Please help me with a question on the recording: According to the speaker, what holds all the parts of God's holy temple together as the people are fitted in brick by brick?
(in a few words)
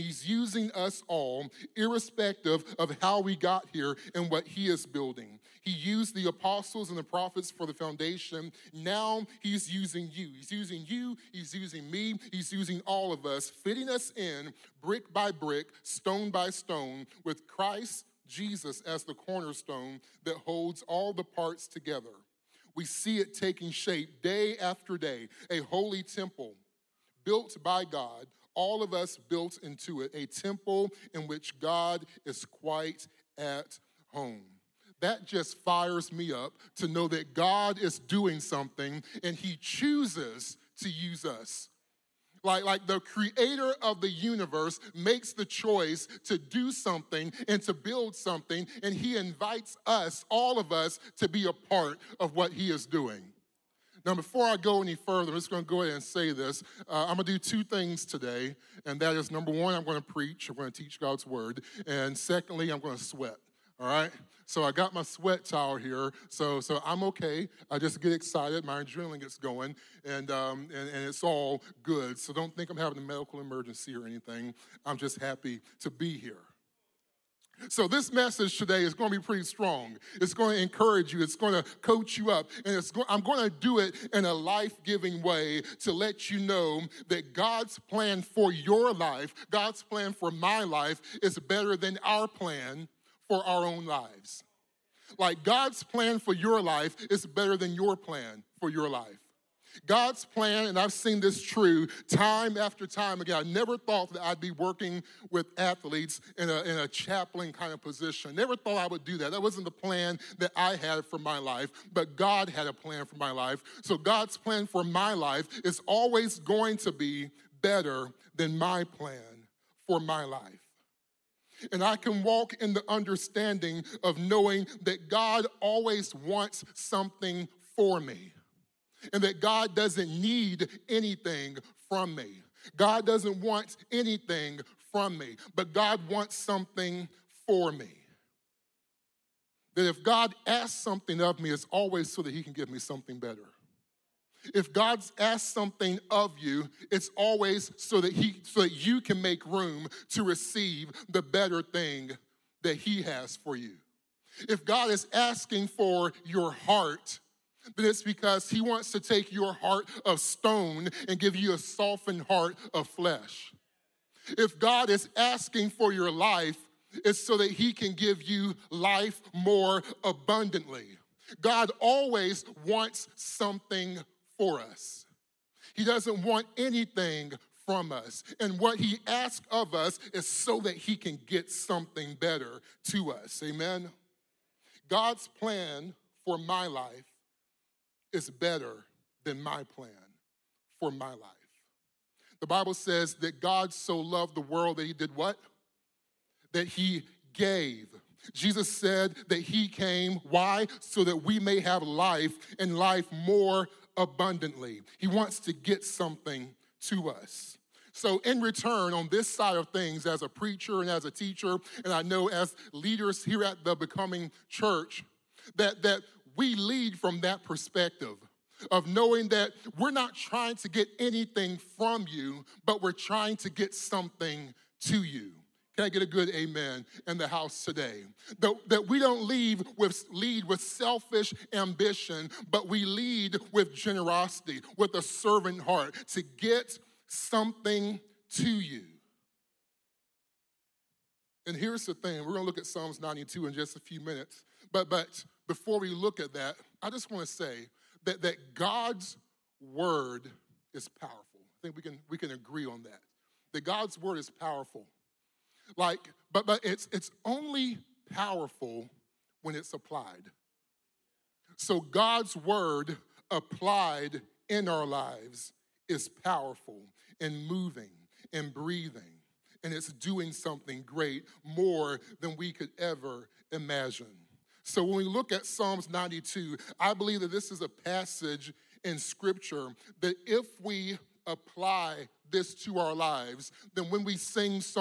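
Christ Jesus.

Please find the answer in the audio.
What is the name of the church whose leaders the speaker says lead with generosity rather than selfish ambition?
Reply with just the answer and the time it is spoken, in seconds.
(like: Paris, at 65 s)
The Becoming Church, at 213 s.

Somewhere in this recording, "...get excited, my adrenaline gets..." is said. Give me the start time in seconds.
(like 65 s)
67 s.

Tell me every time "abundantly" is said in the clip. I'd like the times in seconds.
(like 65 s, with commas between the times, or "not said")
170 s, 203 s.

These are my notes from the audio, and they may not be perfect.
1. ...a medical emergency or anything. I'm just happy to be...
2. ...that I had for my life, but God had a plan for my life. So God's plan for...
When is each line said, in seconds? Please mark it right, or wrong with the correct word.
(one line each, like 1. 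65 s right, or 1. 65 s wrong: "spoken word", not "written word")
1. 72 s right
2. 110 s right.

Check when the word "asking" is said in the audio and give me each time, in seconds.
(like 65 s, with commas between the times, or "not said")
155 s, 165 s.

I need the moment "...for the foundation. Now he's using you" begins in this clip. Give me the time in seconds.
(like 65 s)
7 s.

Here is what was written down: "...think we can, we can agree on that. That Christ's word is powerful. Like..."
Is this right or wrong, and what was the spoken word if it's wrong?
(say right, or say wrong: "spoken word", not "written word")
wrong: "God", not "Christ".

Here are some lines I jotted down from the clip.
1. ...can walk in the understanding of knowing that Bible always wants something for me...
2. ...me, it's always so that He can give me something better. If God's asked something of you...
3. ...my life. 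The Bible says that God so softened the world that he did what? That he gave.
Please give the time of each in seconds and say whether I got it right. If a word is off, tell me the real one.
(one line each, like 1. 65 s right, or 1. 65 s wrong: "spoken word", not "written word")
1. 121 s wrong: "God", not "Bible"
2. 141 s right
3. 190 s wrong: "loved", not "softened".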